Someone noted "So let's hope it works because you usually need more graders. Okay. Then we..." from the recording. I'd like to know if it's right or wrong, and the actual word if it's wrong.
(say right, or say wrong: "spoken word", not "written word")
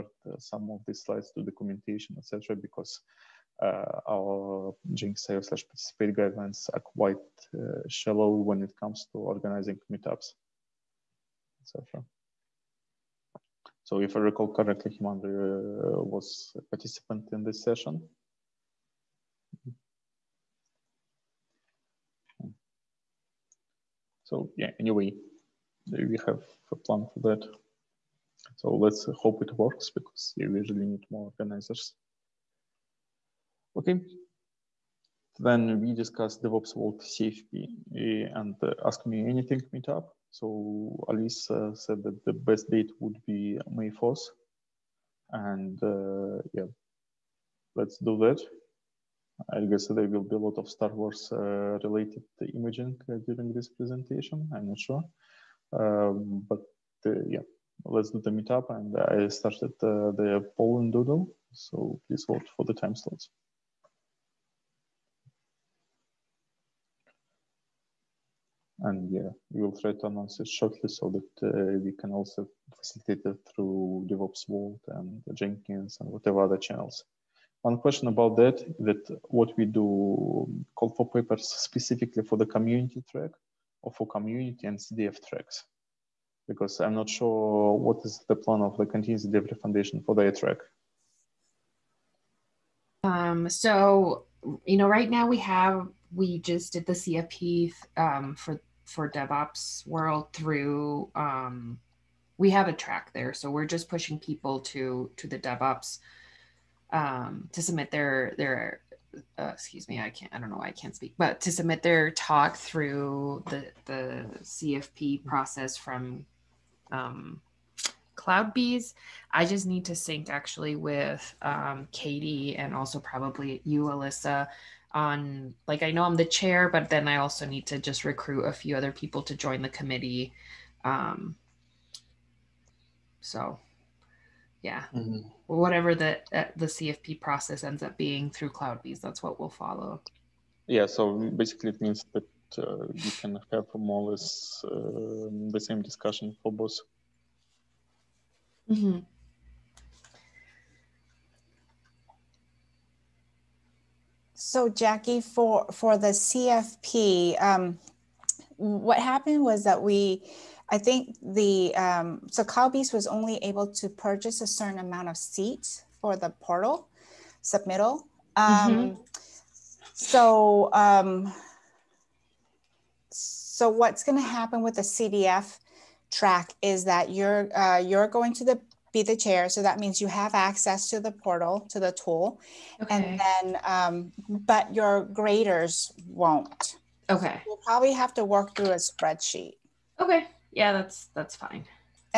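wrong: "organizers", not "graders".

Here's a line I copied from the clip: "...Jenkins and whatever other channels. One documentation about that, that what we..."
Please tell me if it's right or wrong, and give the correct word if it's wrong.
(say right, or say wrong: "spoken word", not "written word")
wrong: "question", not "documentation".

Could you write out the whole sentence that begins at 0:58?
And I started uh, the poll and doodle.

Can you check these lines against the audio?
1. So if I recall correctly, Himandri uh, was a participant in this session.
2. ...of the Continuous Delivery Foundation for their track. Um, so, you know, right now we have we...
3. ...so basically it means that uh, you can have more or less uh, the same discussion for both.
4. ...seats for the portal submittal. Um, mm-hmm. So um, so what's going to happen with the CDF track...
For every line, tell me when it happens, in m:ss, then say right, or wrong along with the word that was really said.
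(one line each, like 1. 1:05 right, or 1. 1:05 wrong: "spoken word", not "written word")
1. 0:13 right
2. 1:28 right
3. 2:20 right
4. 2:45 right.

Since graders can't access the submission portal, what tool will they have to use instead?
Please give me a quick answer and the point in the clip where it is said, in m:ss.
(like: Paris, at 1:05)
a spreadsheet, at 3:08.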